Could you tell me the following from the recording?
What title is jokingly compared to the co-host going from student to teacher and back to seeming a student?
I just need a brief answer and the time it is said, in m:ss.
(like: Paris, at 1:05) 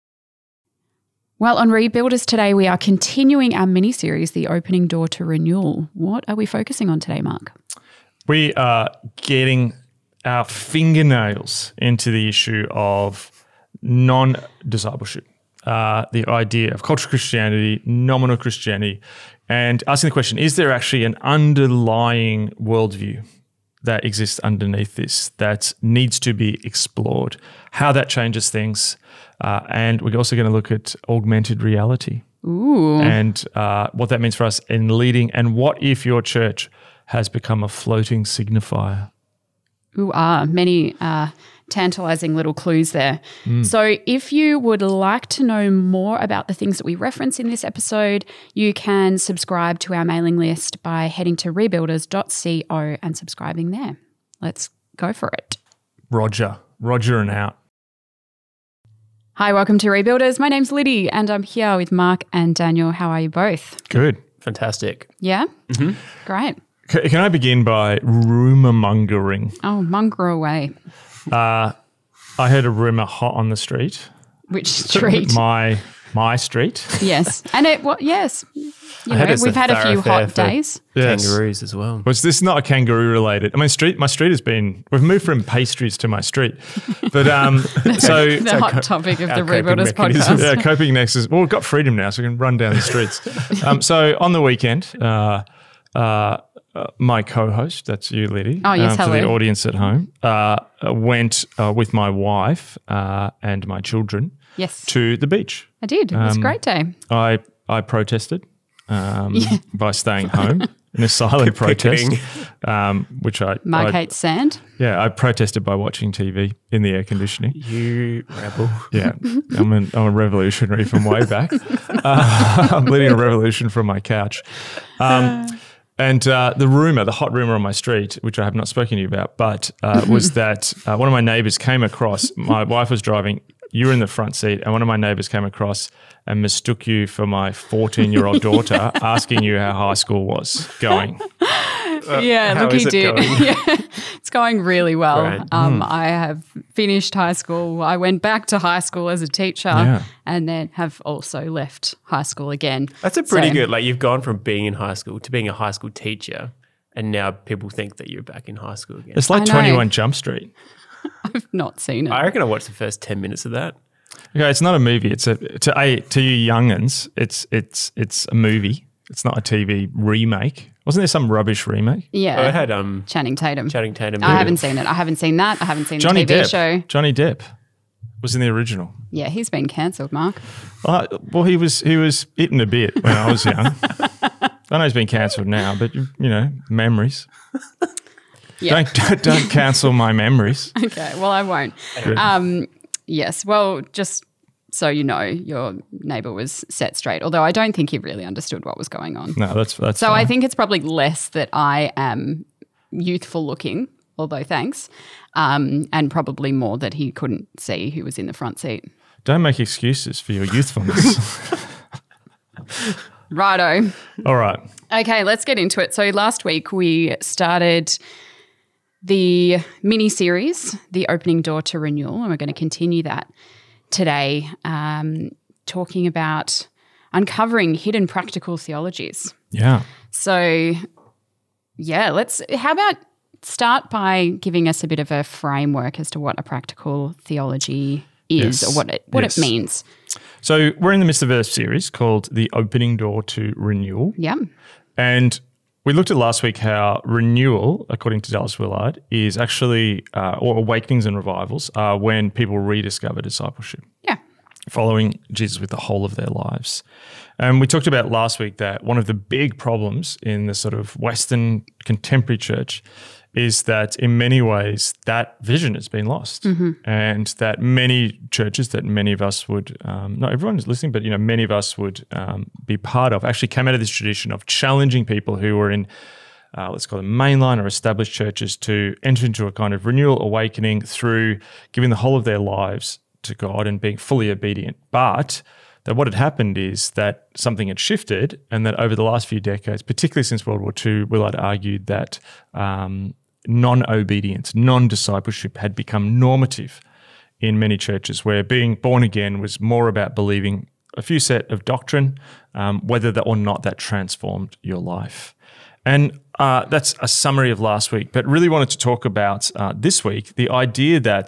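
Twenty One Jump Street, at 2:39.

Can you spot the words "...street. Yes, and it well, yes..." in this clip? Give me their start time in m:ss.
1:16.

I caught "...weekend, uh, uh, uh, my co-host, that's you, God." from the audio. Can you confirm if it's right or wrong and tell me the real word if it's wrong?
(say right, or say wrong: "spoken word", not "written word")
wrong: "Liddy", not "God".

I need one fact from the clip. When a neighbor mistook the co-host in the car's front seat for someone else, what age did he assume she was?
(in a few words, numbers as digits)
14.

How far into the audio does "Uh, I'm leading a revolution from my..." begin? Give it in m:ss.
2:01.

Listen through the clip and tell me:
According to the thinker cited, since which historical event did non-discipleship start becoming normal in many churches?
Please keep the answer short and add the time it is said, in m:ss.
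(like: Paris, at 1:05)
World War II, at 4:50.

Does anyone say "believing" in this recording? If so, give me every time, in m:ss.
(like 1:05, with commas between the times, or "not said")
5:00.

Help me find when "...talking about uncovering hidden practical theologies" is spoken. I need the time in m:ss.
3:45.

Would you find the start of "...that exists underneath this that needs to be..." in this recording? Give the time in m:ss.
0:23.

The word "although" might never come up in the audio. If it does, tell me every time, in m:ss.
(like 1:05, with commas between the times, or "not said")
3:17, 3:24.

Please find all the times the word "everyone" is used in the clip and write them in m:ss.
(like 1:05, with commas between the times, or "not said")
4:30.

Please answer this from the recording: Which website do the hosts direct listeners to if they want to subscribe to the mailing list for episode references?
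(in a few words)
rebuilders.co.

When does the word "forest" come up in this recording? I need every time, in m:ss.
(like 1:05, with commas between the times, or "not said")
not said.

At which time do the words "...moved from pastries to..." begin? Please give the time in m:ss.
1:25.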